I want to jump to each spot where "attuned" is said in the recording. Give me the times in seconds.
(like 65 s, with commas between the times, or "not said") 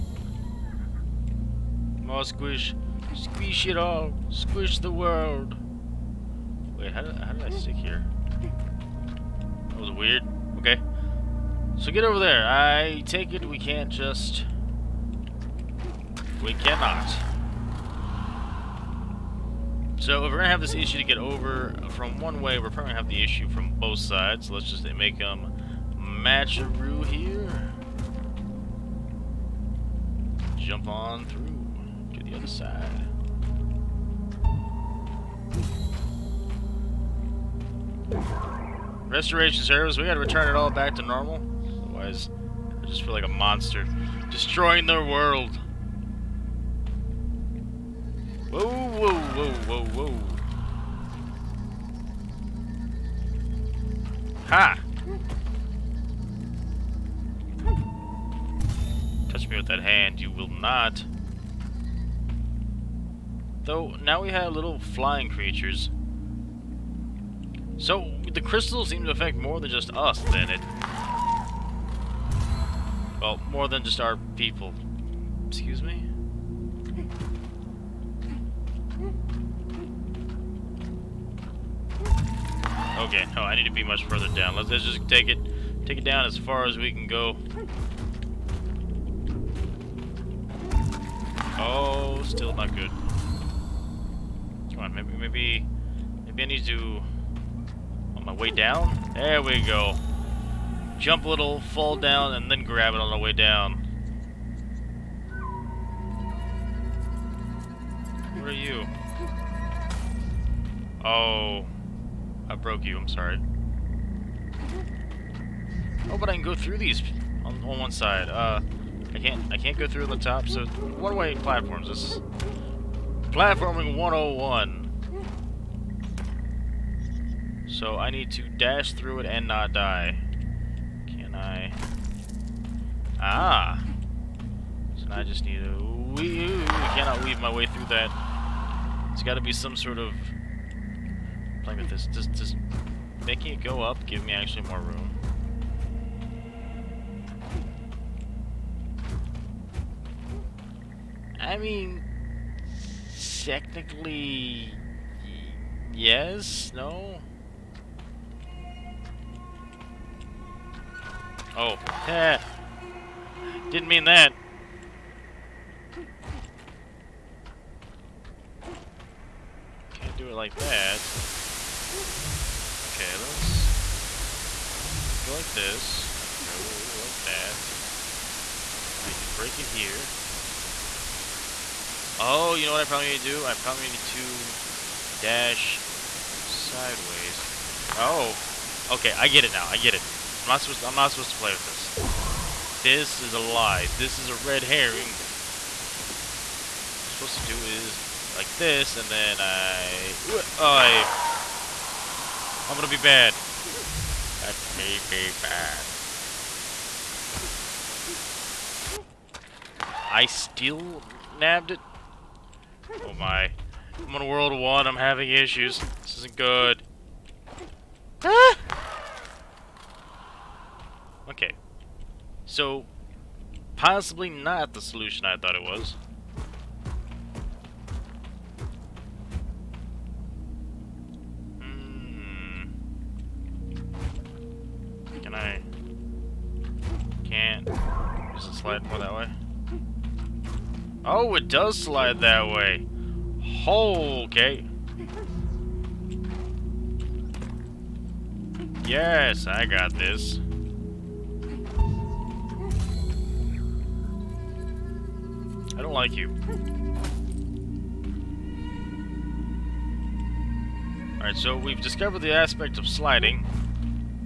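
not said.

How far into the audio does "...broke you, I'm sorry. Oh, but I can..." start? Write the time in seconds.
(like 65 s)
112 s.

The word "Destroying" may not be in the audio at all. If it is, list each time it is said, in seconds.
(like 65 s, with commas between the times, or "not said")
44 s.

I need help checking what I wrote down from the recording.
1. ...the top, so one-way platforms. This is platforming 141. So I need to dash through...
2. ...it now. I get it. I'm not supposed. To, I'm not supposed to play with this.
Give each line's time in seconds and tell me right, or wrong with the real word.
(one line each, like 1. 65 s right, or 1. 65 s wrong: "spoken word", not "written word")
1. 120 s wrong: "101", not "141"
2. 189 s right.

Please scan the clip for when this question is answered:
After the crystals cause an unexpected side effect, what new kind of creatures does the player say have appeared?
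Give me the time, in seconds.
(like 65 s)
64 s.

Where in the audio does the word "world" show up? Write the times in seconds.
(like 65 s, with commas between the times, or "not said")
4 s, 45 s, 214 s.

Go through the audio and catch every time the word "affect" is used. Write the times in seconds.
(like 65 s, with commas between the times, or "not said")
69 s.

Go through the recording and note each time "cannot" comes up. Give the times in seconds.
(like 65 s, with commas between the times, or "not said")
16 s, 136 s.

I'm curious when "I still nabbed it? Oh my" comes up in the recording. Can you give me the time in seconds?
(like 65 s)
210 s.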